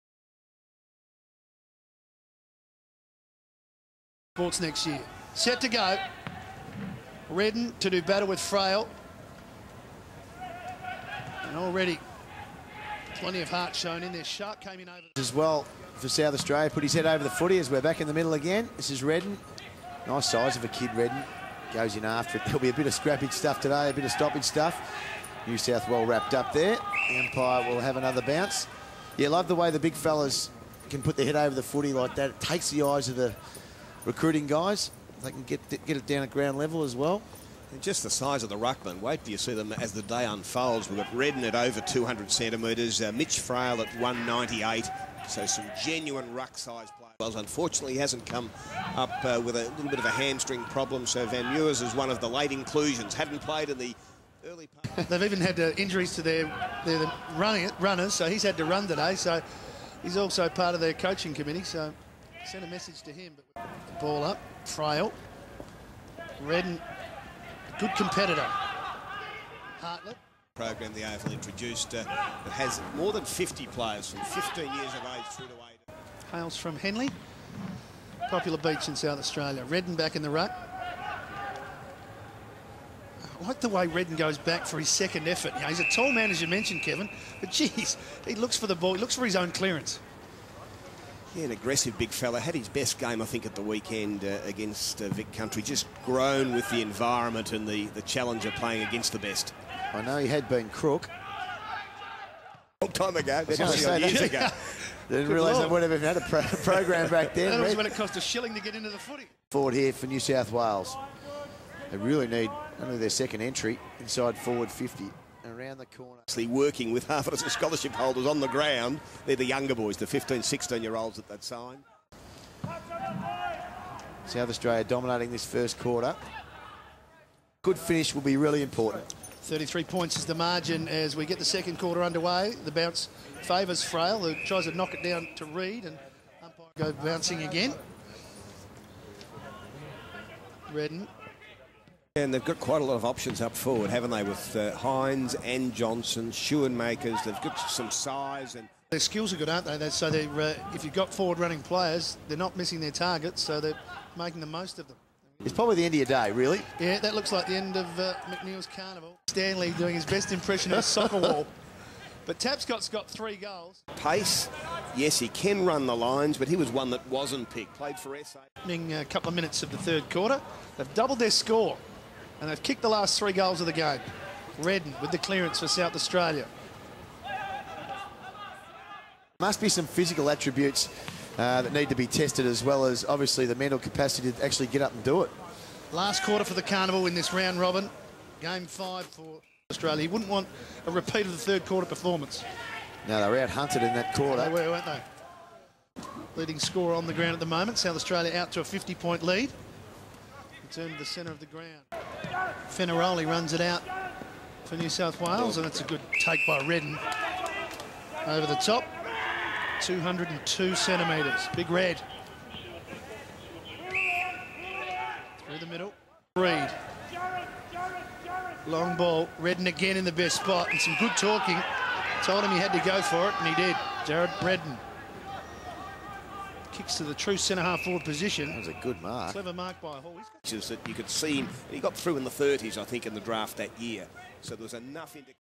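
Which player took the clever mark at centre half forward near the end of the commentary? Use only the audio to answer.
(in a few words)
Hall.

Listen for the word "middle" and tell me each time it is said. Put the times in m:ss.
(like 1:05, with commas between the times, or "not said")
0:18, 3:35.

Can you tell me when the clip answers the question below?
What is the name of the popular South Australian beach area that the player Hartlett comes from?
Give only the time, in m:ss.
1:16.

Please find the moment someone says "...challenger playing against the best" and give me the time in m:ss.
1:38.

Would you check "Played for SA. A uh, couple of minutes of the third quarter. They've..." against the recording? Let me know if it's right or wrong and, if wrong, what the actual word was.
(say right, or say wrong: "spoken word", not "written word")
right.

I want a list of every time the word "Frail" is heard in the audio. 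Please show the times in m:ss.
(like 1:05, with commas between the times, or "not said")
0:08, 0:43, 1:04, 2:13.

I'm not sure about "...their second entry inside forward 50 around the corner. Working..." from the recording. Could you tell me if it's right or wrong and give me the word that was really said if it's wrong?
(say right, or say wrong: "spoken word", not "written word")
right.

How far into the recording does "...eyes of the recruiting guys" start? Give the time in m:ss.
0:32.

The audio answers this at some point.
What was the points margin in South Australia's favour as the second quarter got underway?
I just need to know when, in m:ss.
2:09.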